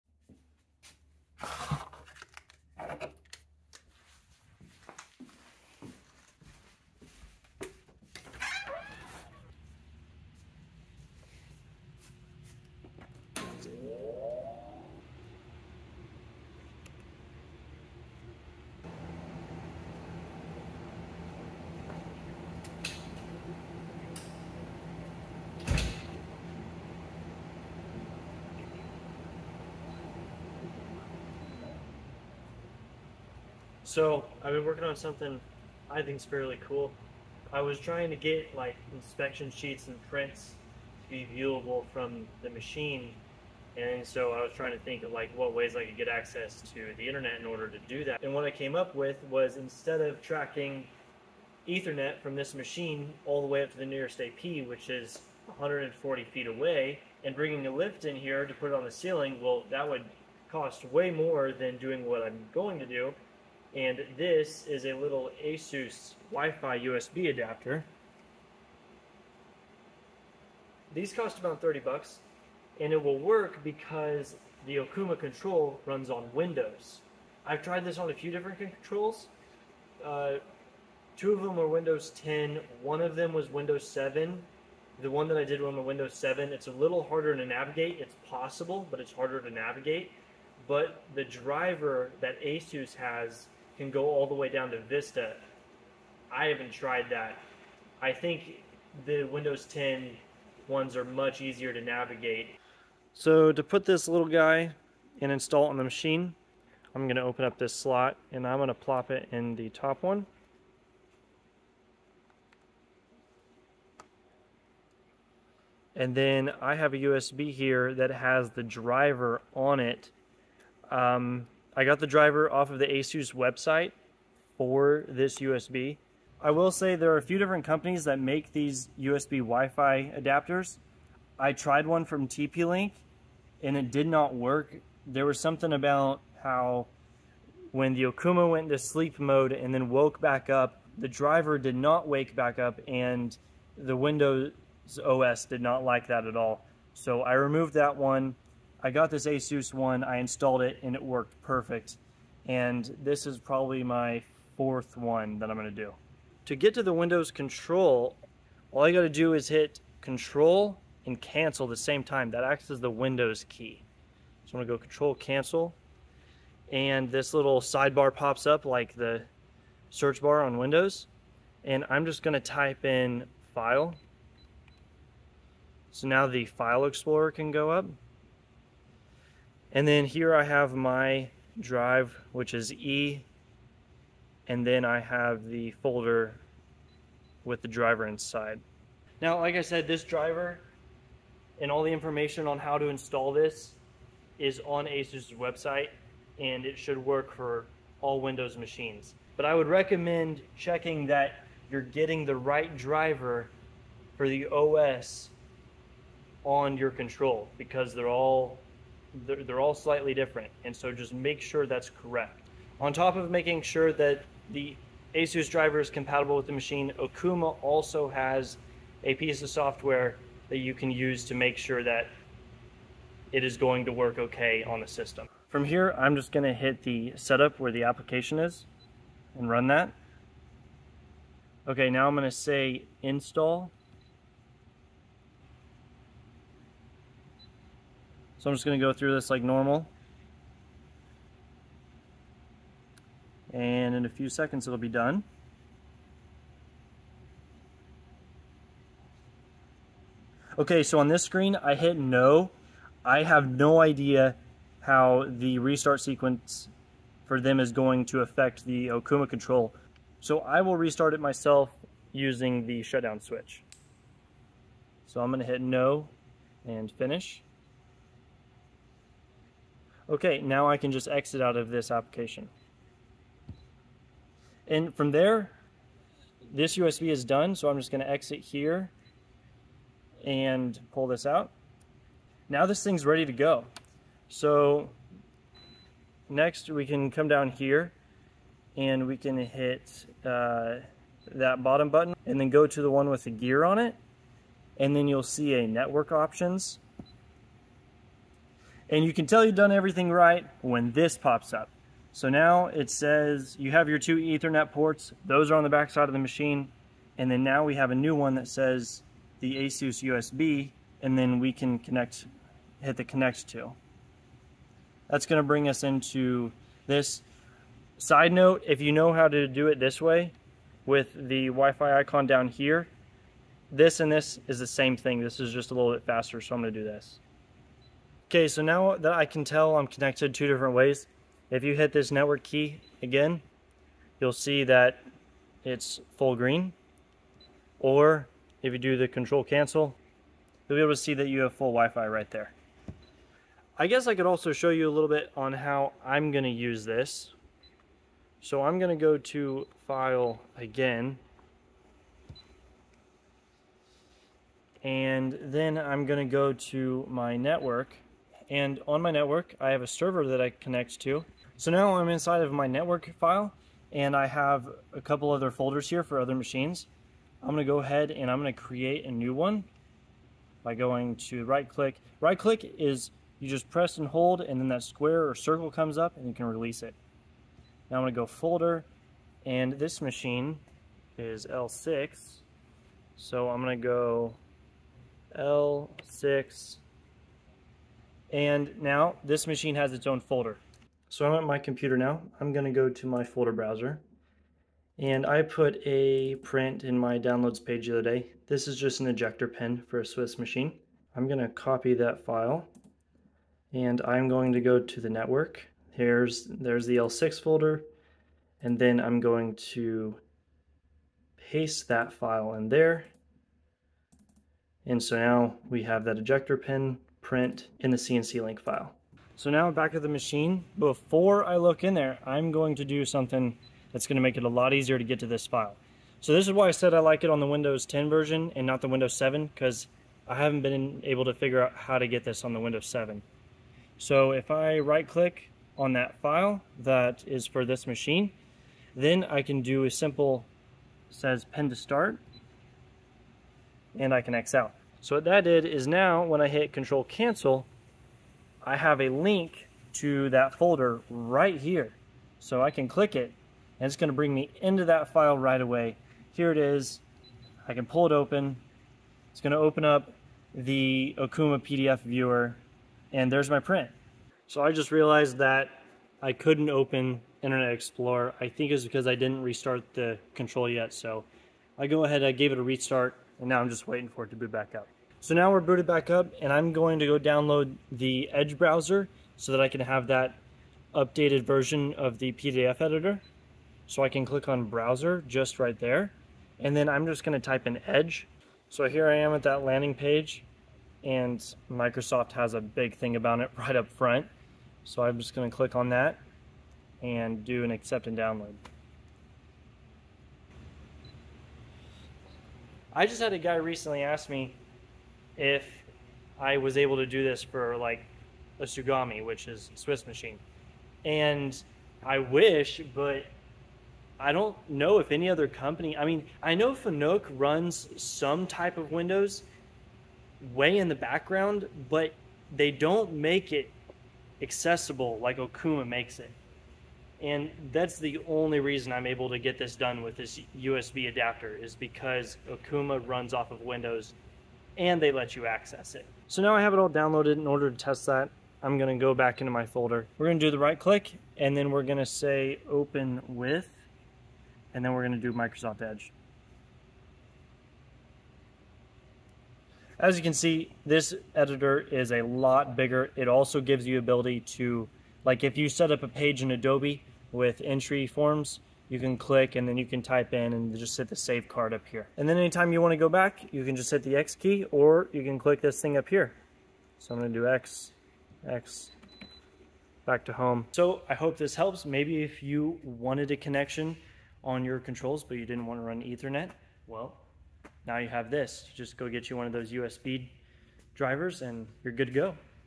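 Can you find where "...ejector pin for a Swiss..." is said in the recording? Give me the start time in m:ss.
6:39.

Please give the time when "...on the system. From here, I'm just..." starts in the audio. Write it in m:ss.
3:44.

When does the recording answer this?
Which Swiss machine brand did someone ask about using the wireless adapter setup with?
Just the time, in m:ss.
8:28.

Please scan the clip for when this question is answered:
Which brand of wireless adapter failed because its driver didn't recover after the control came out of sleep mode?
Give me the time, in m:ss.
2:12.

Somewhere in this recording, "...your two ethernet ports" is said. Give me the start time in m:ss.
5:03.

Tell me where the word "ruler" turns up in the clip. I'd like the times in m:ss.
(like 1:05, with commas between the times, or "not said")
not said.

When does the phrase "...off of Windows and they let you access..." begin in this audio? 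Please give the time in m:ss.
8:53.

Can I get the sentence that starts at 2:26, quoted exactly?
So I removed that one I got this Asus one, I installed it, and it worked perfect.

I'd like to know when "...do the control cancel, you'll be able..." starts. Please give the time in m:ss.
5:38.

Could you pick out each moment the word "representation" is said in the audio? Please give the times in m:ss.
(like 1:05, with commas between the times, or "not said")
not said.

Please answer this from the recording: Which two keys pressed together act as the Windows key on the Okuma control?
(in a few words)
control and cancel.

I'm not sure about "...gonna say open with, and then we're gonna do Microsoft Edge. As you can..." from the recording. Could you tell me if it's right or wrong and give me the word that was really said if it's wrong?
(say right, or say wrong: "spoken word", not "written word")
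right.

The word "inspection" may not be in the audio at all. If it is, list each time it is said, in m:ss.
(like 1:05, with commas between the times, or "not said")
0:38.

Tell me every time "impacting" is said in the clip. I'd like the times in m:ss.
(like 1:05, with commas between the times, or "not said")
not said.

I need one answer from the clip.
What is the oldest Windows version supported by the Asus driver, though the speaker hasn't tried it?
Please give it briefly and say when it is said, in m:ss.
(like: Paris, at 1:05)
Vista, at 1:34.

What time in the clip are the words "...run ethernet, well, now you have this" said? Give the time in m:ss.
9:35.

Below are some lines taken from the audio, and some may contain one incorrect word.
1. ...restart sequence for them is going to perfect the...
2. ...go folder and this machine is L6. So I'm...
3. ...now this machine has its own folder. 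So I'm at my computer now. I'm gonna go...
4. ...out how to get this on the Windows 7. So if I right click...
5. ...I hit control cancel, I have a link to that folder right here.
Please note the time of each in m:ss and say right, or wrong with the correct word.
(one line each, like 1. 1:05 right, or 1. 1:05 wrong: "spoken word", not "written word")
1. 4:15 wrong: "affect", not "perfect"
2. 6:18 right
3. 6:28 right
4. 7:11 right
5. 7:26 right.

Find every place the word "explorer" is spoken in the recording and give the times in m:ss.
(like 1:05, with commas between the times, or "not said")
2:56, 7:47.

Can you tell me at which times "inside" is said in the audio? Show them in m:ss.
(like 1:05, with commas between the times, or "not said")
3:08, 6:02.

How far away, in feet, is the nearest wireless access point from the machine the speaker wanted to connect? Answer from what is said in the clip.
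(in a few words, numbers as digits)
140 feet.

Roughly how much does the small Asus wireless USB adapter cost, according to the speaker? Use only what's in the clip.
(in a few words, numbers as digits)
$30.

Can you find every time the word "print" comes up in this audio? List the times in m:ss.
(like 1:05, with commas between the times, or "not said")
0:40, 6:36, 6:57, 7:43.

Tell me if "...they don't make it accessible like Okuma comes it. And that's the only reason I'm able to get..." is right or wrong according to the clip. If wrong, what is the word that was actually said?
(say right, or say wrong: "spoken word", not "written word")
wrong: "makes", not "comes".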